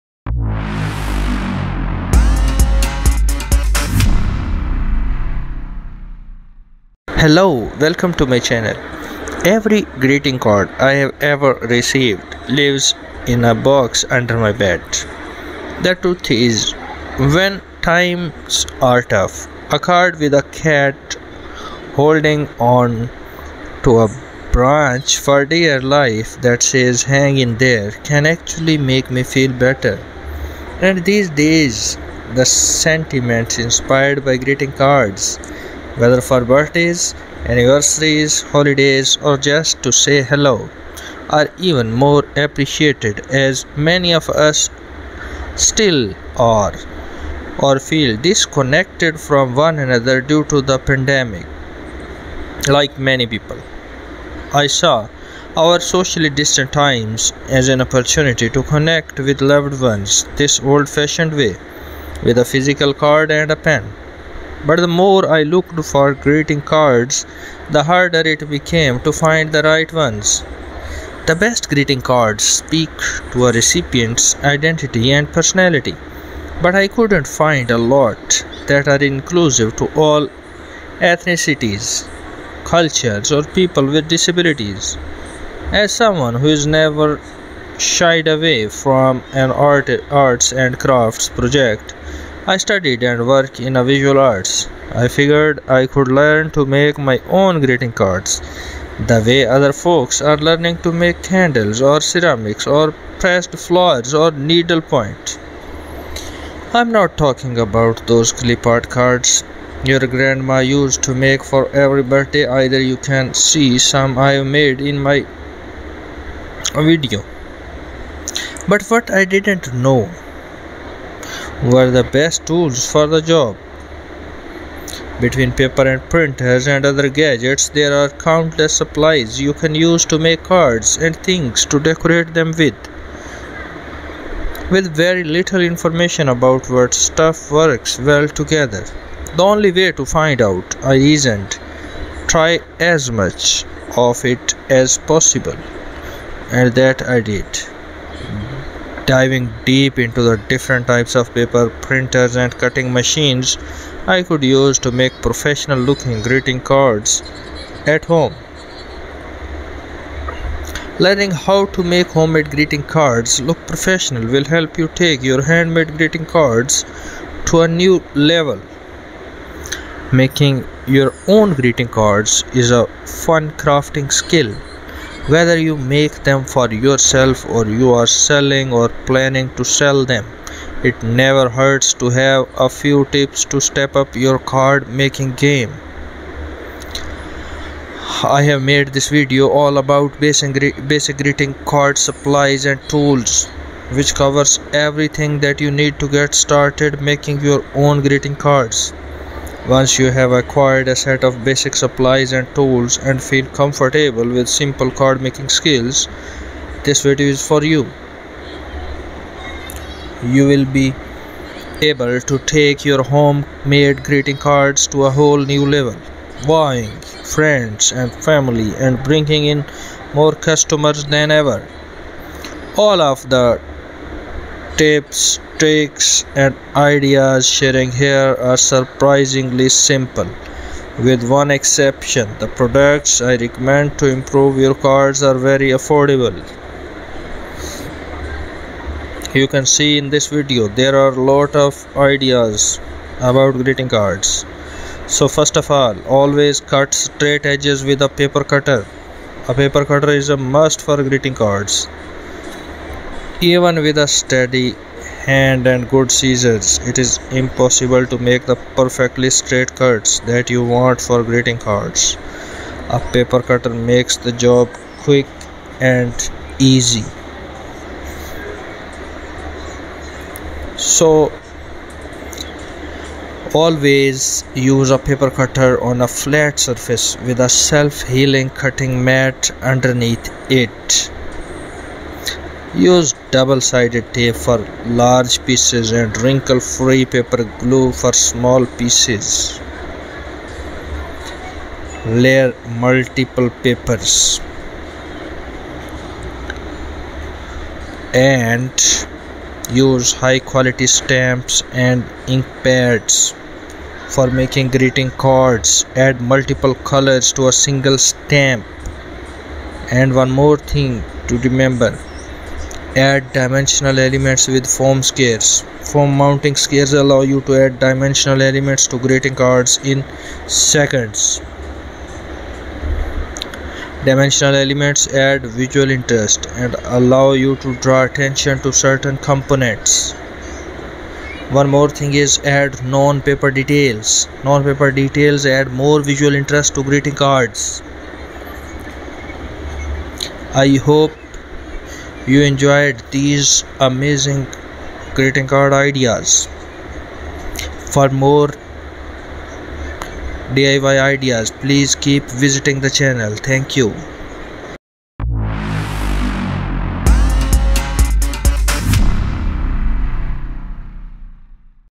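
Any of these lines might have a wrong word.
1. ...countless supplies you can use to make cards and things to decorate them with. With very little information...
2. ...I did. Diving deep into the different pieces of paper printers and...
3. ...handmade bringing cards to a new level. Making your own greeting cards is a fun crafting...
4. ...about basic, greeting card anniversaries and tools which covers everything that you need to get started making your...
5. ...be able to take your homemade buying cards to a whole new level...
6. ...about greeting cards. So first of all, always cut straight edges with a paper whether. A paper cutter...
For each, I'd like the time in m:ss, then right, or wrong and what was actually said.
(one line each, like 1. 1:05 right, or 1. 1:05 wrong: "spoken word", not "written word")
1. 2:08 right
2. 2:27 wrong: "types", not "pieces"
3. 2:45 wrong: "greeting", not "bringing"
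4. 3:09 wrong: "supplies", not "anniversaries"
5. 3:30 wrong: "greeting", not "buying"
6. 4:03 wrong: "cutter", not "whether".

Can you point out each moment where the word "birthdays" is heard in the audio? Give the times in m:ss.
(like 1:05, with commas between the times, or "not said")
0:36, 1:52.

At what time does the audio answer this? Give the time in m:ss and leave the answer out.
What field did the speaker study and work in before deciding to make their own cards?
1:33.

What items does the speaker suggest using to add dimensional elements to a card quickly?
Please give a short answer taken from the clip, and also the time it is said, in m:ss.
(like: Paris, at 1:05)
Foam squares, at 5:14.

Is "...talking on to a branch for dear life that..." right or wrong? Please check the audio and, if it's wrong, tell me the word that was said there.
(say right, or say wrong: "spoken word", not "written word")
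wrong: "holding", not "talking".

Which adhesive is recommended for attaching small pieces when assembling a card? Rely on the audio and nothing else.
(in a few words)
Wrinkle-free paper glue.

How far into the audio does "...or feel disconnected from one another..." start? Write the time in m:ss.
0:47.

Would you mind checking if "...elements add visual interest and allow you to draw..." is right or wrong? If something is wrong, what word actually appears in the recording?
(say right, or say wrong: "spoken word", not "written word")
right.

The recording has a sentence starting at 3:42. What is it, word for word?
All of the tips, tricks and ideas sharing here are surprisingly simple.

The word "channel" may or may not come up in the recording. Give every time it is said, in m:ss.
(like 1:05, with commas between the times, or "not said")
0:08, 5:52.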